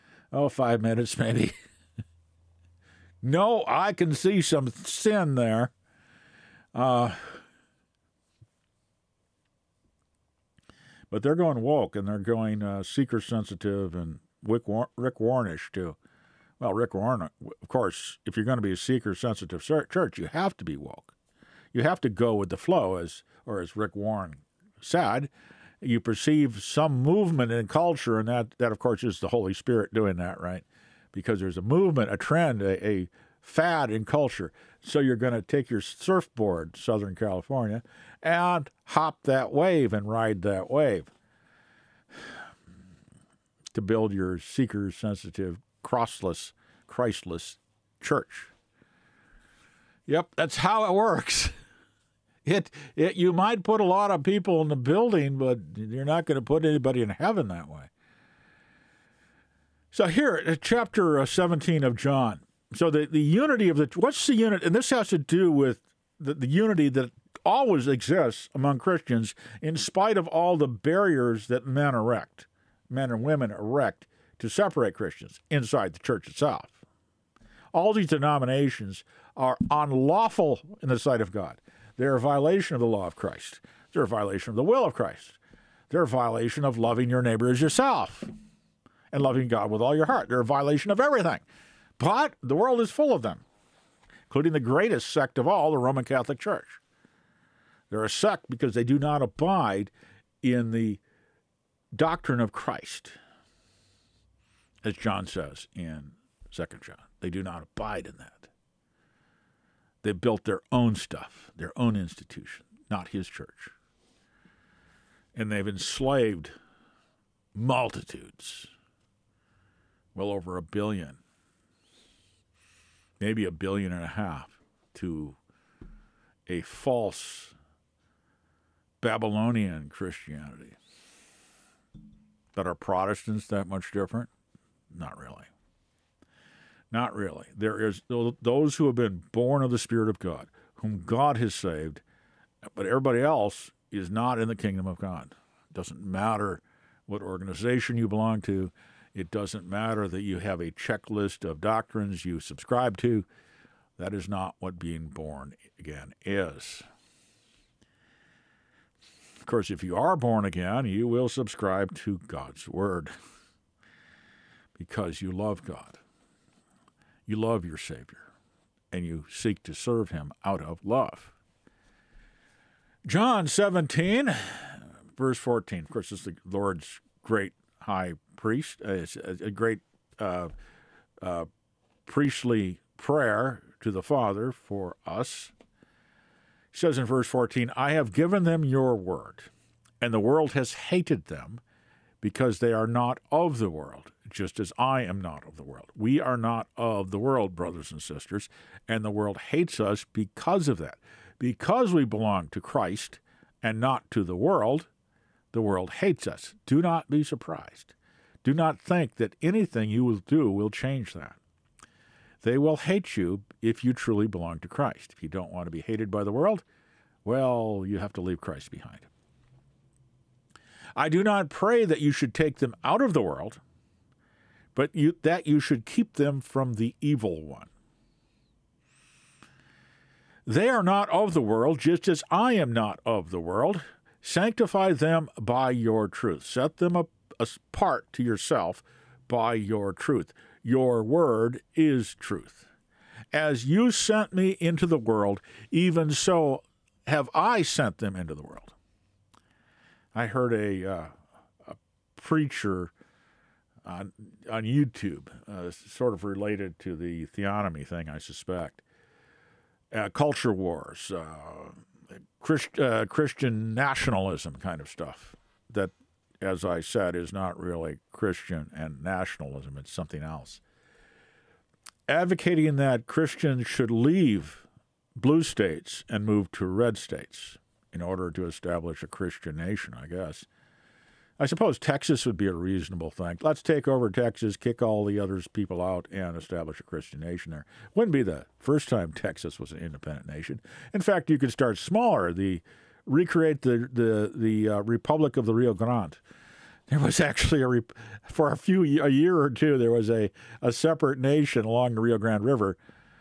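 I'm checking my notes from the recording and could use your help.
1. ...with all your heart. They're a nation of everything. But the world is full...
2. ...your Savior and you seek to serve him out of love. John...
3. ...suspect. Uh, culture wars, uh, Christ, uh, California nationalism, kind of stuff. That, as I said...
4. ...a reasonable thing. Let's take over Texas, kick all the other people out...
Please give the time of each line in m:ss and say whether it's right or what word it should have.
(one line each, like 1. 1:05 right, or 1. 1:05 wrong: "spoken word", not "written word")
1. 1:29 wrong: "violation", not "nation"
2. 2:47 right
3. 4:18 wrong: "Christian", not "California"
4. 4:42 right.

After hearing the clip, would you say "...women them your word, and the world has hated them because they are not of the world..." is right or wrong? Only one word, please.
wrong.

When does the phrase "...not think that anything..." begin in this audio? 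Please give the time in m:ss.
3:28.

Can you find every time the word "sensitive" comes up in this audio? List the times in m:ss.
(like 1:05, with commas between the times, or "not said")
0:13, 0:19, 0:44.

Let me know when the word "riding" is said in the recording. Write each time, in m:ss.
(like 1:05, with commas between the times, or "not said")
not said.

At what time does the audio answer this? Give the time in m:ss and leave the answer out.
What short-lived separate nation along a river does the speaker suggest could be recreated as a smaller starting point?
4:54.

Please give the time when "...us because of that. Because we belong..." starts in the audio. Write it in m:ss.
3:19.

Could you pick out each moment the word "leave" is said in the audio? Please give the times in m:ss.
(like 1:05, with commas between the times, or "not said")
3:38, 4:33.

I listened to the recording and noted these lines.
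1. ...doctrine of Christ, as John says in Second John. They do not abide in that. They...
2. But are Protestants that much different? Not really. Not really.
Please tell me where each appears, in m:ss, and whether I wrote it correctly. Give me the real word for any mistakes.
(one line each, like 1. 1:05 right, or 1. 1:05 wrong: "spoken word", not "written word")
1. 1:41 right
2. 2:12 right.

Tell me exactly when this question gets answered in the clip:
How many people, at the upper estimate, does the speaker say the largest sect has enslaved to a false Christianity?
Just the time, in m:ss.
2:03.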